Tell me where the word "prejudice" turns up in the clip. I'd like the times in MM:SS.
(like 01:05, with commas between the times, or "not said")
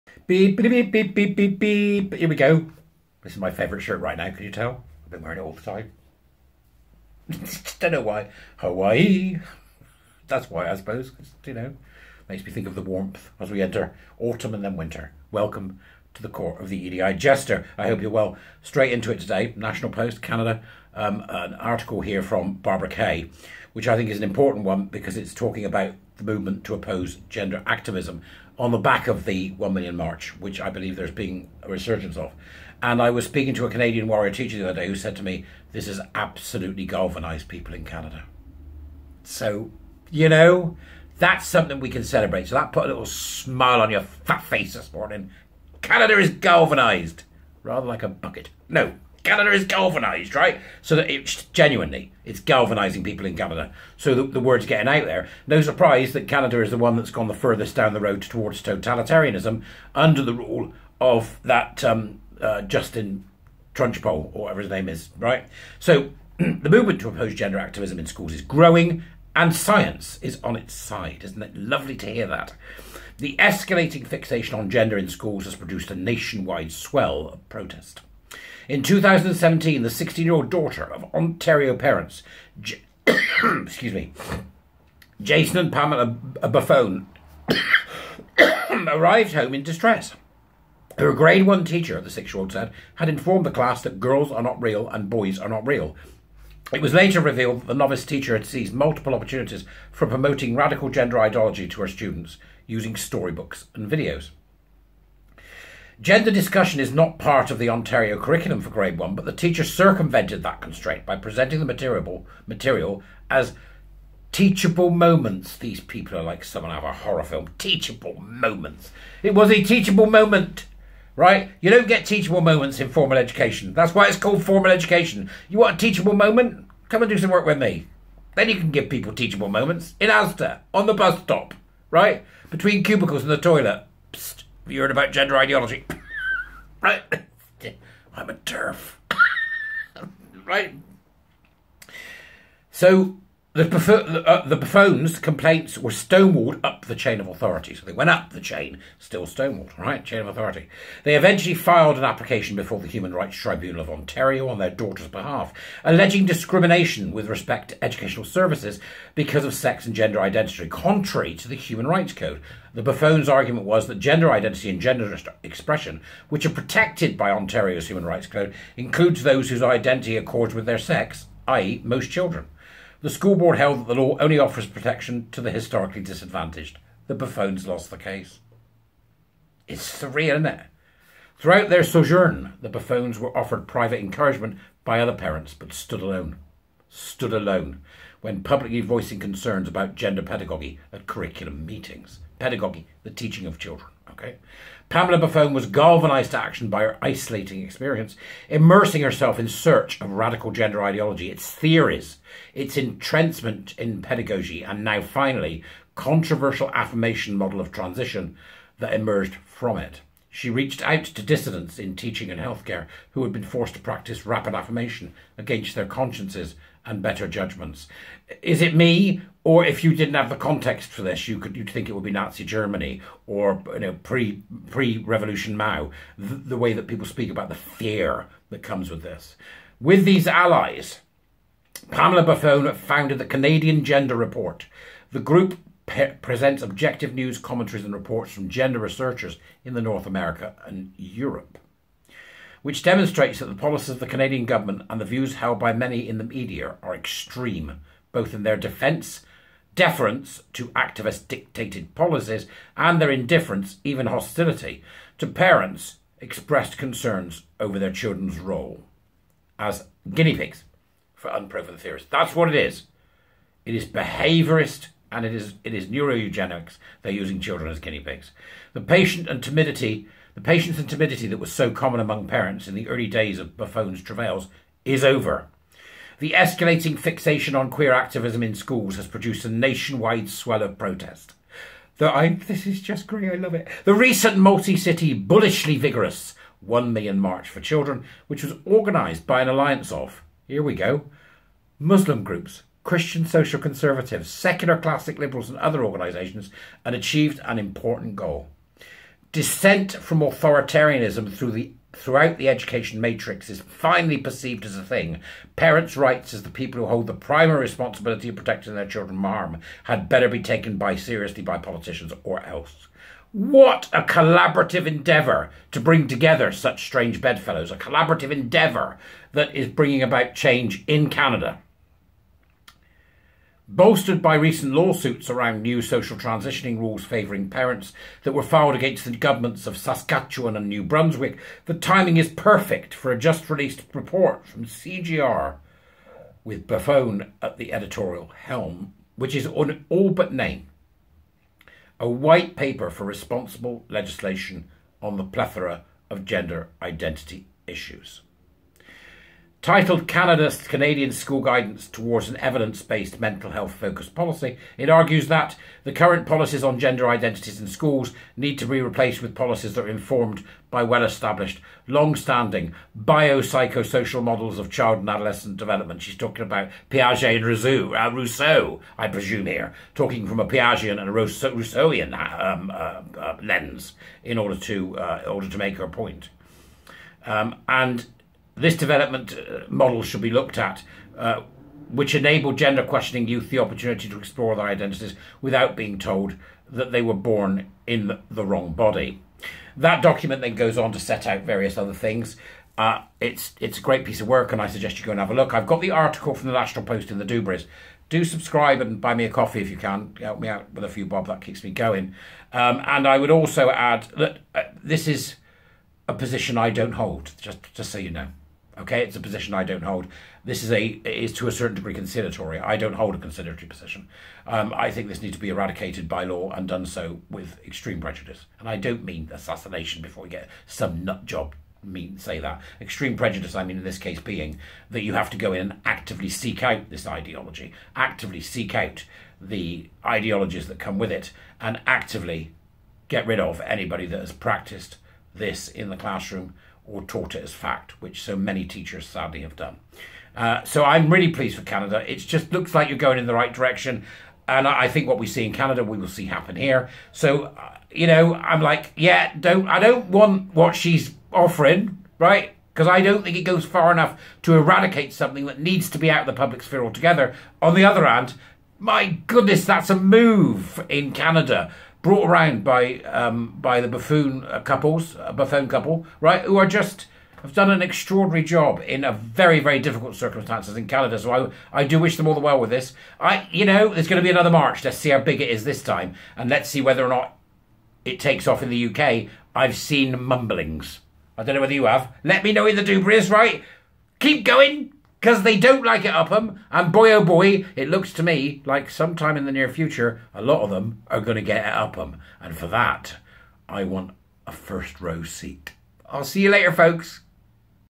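06:57, 07:03.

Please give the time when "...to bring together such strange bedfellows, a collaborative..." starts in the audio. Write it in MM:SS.
05:15.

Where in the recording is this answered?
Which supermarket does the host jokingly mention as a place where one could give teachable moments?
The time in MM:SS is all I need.
02:10.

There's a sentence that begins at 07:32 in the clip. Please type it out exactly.
Because I don't think it goes far enough to eradicate something that needs to be out of the public sphere altogether.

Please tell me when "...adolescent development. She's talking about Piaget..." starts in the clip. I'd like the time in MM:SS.
06:05.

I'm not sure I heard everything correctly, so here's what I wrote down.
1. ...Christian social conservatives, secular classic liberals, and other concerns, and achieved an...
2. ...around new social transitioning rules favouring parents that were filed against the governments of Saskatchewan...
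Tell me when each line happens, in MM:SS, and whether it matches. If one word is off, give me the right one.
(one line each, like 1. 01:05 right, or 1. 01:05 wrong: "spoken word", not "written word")
1. 04:52 wrong: "organisations", not "concerns"
2. 05:25 right.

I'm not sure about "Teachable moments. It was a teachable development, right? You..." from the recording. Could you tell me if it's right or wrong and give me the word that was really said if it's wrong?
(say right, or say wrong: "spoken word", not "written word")
wrong: "moment", not "development".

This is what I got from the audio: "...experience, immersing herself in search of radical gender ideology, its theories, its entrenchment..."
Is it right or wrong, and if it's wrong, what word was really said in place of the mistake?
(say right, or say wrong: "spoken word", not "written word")
right.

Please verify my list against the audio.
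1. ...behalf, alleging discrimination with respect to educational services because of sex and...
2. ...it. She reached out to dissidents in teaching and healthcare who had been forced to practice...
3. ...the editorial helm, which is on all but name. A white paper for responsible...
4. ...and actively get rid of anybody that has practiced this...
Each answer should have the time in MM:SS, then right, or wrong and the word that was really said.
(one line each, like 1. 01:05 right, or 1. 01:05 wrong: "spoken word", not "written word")
1. 02:35 right
2. 03:29 right
3. 05:37 right
4. 07:11 right.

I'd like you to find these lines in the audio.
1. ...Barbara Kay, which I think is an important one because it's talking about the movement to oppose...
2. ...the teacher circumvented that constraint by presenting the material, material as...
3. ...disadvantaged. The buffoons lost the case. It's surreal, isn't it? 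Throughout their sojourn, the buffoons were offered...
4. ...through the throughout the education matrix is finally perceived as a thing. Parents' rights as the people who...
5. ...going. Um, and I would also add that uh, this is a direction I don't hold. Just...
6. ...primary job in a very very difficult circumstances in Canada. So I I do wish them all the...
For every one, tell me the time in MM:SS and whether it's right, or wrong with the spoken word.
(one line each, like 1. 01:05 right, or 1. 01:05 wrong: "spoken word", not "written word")
1. 00:22 right
2. 01:49 right
3. 02:56 right
4. 05:01 right
5. 06:41 wrong: "position", not "direction"
6. 07:47 wrong: "extraordinary", not "primary".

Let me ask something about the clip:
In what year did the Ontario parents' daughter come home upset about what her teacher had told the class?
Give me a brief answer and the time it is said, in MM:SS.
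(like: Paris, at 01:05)
2017, at 01:18.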